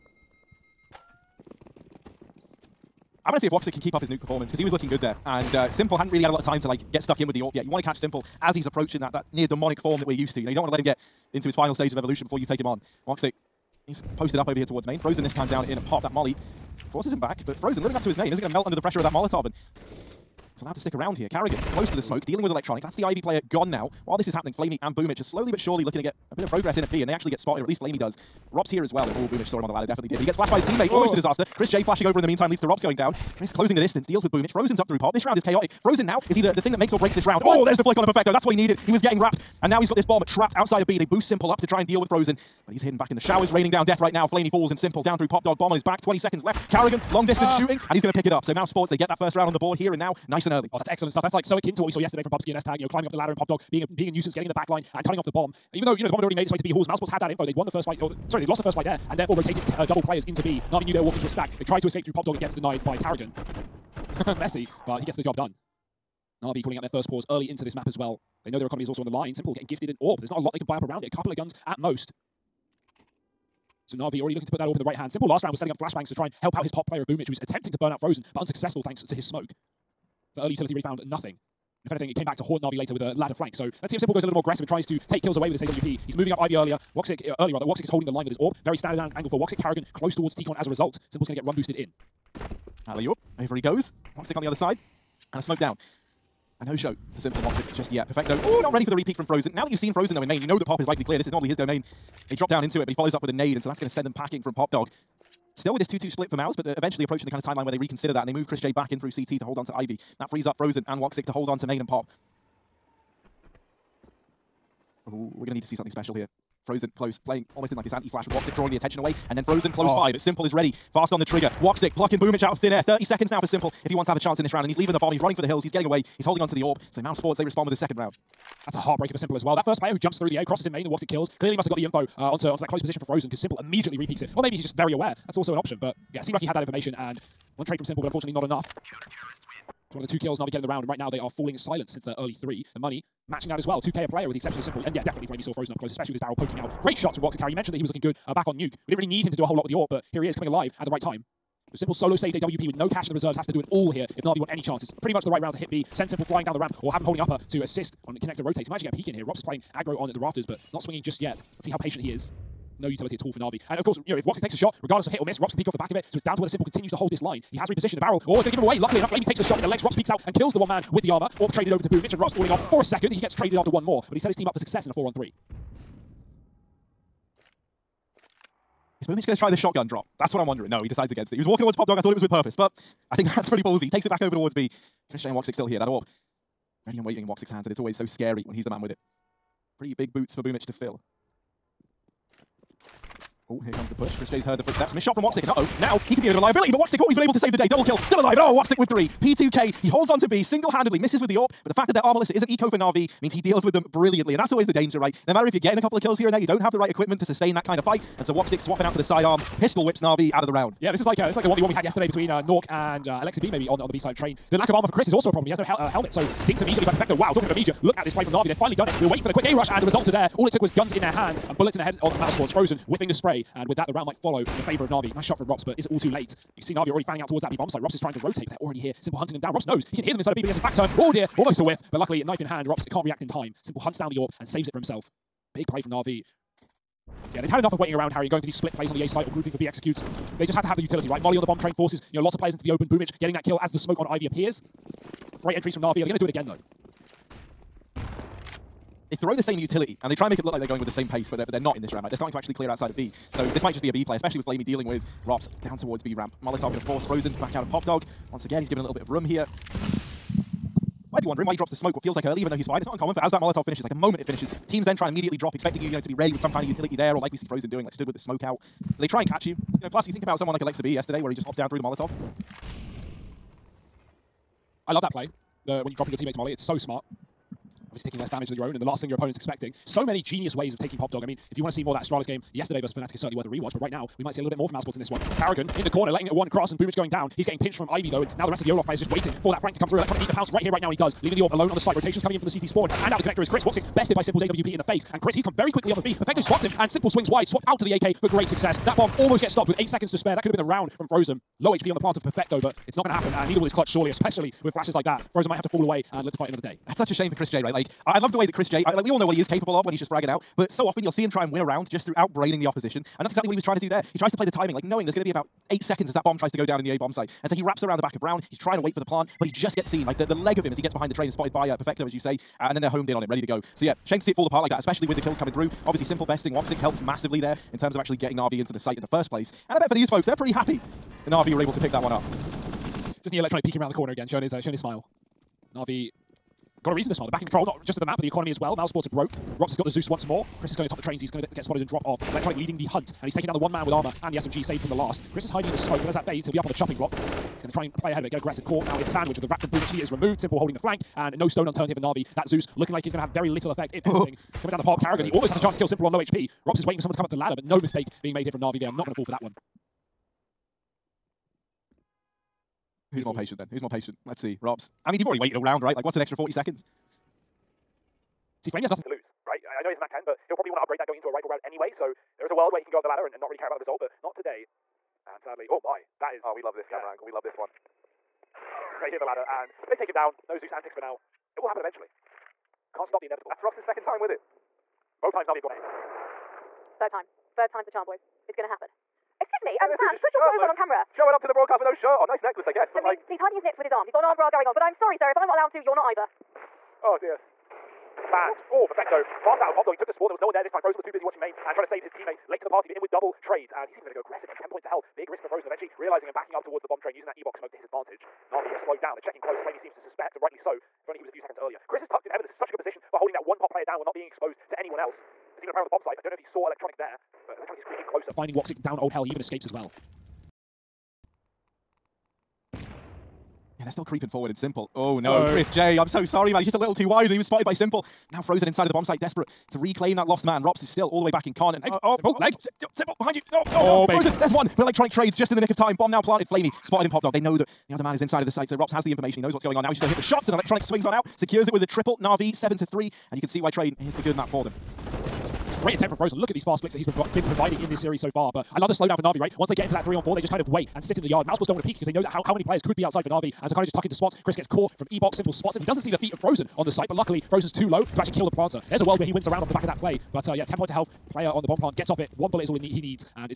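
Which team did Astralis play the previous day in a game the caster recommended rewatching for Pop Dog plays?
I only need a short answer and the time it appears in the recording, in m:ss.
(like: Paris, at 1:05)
Fnatic, at 4:42.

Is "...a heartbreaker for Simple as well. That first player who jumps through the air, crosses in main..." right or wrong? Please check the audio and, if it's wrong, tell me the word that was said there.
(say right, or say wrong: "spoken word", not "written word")
right.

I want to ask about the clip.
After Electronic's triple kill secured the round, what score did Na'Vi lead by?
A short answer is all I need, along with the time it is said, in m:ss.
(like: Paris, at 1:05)
7 to 3, at 7:22.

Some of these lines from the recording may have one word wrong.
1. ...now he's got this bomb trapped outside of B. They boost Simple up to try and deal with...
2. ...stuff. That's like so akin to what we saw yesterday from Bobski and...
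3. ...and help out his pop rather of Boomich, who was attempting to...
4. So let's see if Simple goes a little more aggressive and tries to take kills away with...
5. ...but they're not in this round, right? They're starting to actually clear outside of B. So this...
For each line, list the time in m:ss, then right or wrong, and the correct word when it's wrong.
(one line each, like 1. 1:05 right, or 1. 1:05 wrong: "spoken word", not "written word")
1. 0:39 right
2. 0:51 right
3. 1:16 wrong: "player", not "rather"
4. 1:23 right
5. 4:11 right.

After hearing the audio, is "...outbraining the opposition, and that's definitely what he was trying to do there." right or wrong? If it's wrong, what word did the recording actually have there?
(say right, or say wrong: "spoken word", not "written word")
wrong: "exactly", not "definitely".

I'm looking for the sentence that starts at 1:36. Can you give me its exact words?
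And Osho for Simple and Woxic just yet.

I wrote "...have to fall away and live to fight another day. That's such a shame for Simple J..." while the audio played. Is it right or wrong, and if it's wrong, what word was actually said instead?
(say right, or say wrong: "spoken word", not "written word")
wrong: "Chris", not "Simple".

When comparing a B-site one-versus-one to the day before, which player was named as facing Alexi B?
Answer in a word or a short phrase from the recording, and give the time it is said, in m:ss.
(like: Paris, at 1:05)
Nork, at 3:32.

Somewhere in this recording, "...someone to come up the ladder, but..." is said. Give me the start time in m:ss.
5:57.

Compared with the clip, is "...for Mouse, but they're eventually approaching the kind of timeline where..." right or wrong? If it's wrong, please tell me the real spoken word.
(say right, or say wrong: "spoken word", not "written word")
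right.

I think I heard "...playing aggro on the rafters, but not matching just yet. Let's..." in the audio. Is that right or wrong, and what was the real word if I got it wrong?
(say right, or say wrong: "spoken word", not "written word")
wrong: "swinging", not "matching".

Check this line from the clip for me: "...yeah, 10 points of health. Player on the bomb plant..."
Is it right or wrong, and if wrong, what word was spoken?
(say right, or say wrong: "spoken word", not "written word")
right.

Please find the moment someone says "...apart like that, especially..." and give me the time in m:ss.
5:24.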